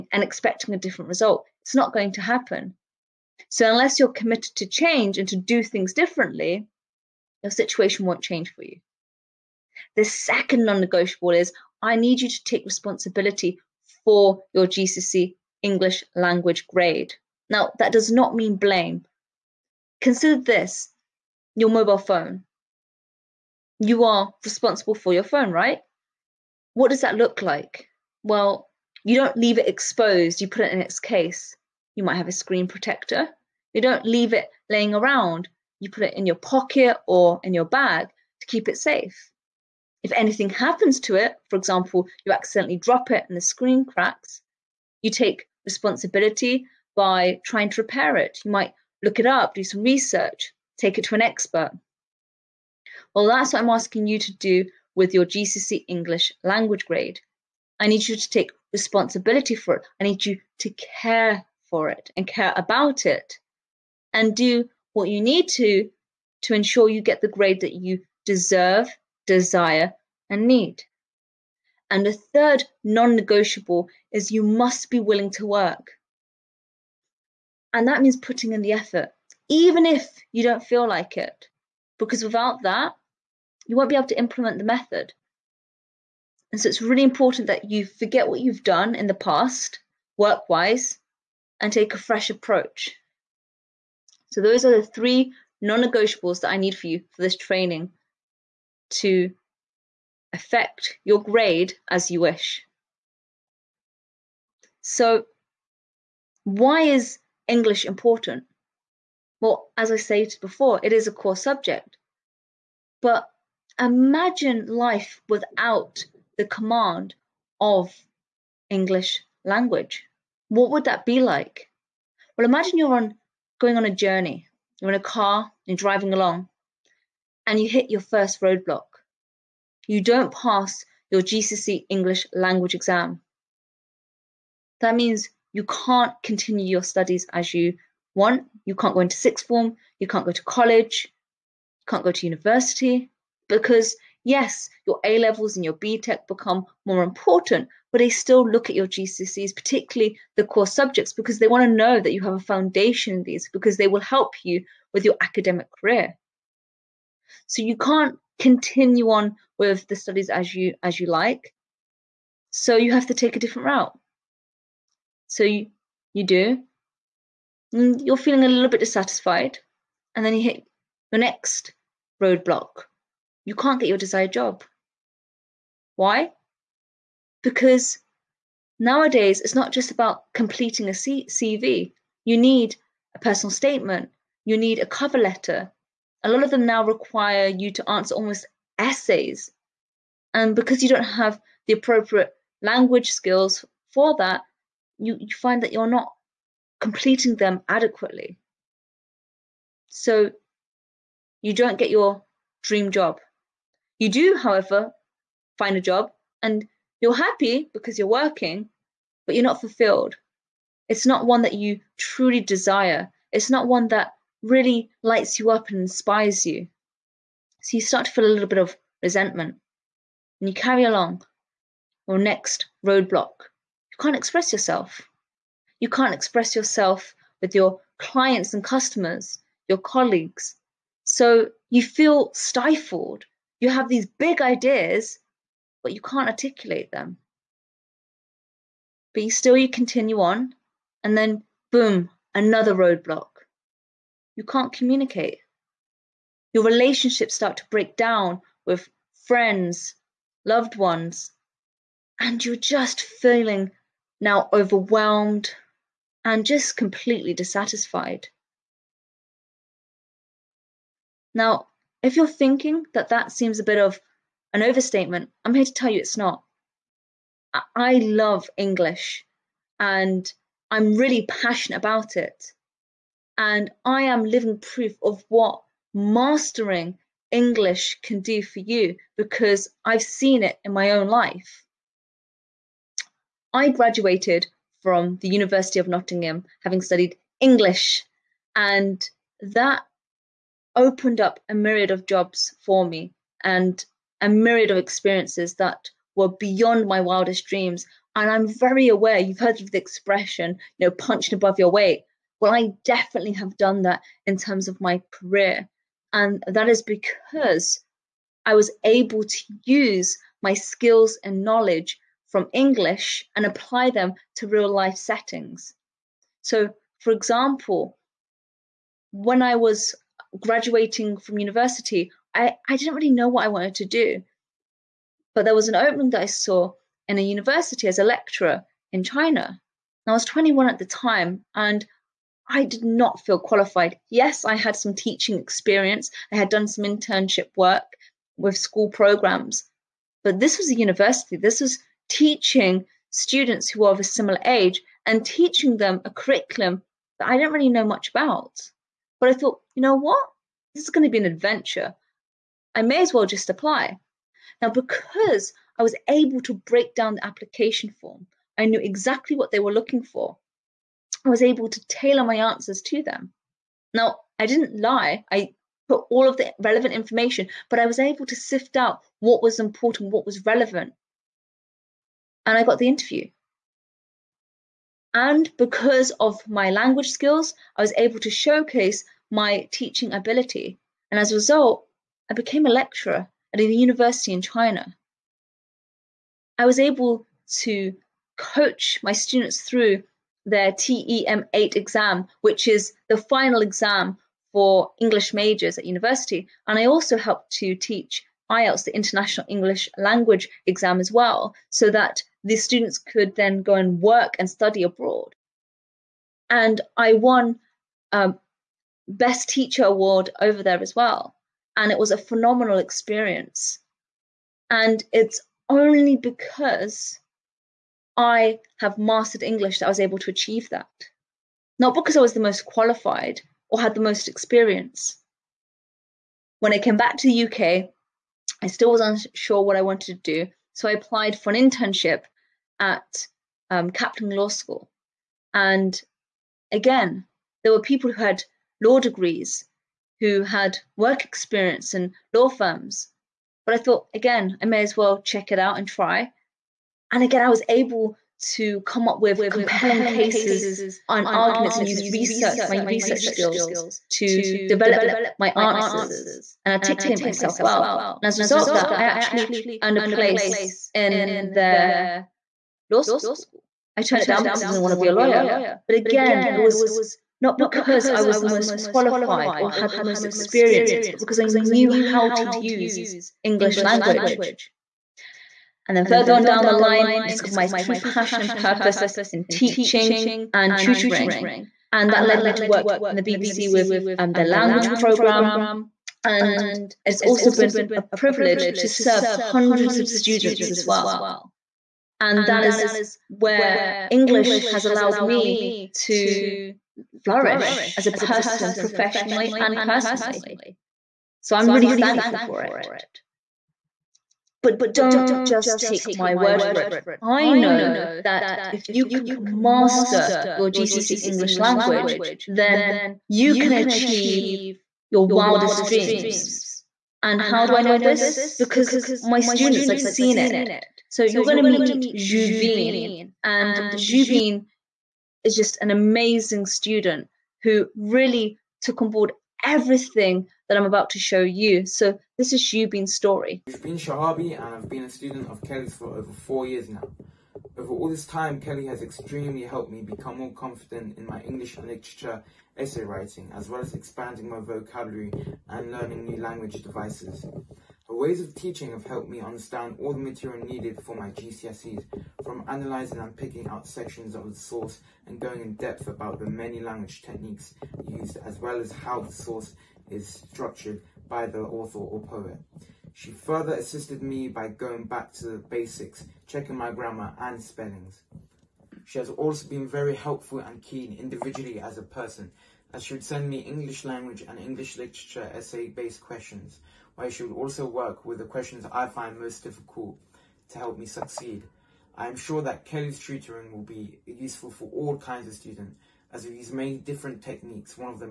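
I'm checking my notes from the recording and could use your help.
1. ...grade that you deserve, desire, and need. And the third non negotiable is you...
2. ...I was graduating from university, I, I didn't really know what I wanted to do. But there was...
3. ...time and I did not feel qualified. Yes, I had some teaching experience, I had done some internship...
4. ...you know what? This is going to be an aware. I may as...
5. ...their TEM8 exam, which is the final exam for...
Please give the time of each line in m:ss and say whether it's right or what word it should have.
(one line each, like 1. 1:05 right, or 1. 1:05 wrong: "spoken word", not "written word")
1. 1:07 right
2. 5:19 right
3. 5:30 right
4. 5:49 wrong: "adventure", not "aware"
5. 6:30 right.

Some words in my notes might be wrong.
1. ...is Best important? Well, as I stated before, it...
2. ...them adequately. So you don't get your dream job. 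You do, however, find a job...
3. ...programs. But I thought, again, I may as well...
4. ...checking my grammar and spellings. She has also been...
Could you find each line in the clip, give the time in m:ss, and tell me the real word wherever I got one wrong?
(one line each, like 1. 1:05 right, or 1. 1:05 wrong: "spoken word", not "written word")
1. 1:46 wrong: "English", not "Best"
2. 3:17 right
3. 7:22 wrong: "firms", not "programs"
4. 9:26 right.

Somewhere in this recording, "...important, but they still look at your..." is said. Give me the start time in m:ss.
2:27.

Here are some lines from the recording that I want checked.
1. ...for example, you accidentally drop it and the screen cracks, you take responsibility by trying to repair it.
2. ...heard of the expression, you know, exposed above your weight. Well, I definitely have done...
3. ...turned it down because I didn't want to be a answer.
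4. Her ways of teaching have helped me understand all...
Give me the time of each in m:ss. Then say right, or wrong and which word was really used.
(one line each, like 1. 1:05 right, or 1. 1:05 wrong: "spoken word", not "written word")
1. 0:41 right
2. 4:59 wrong: "punched", not "exposed"
3. 7:44 wrong: "lawyer", not "answer"
4. 9:08 right.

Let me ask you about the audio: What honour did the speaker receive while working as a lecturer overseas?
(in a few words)
Best Teacher Award.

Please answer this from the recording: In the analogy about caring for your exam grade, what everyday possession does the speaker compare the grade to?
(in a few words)
Mobile phone.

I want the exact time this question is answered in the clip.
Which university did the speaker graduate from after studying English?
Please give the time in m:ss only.
4:45.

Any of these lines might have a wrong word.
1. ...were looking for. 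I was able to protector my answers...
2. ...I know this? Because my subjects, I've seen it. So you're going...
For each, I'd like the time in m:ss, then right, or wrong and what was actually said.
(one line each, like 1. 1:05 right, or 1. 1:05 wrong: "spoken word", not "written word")
1. 5:59 wrong: "tailor", not "protector"
2. 8:37 wrong: "students", not "subjects".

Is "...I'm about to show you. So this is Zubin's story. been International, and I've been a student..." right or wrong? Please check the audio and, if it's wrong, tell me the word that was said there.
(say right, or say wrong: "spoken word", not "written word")
wrong: "Shahabi", not "International".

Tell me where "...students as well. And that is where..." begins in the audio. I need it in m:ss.
8:10.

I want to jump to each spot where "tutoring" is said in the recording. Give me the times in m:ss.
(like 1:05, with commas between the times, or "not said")
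8:00, 9:43.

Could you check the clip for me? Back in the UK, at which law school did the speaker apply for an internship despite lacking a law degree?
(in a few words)
Kaplan Law School.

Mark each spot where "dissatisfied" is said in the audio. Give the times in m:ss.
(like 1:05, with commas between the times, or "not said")
2:48, 4:17.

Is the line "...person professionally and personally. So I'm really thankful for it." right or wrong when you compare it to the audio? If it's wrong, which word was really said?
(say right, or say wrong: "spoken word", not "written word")
right.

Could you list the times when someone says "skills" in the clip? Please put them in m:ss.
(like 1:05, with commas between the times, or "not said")
3:13, 5:10, 6:17, 7:33.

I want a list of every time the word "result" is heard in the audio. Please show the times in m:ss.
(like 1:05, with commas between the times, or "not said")
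0:01, 6:21, 7:38.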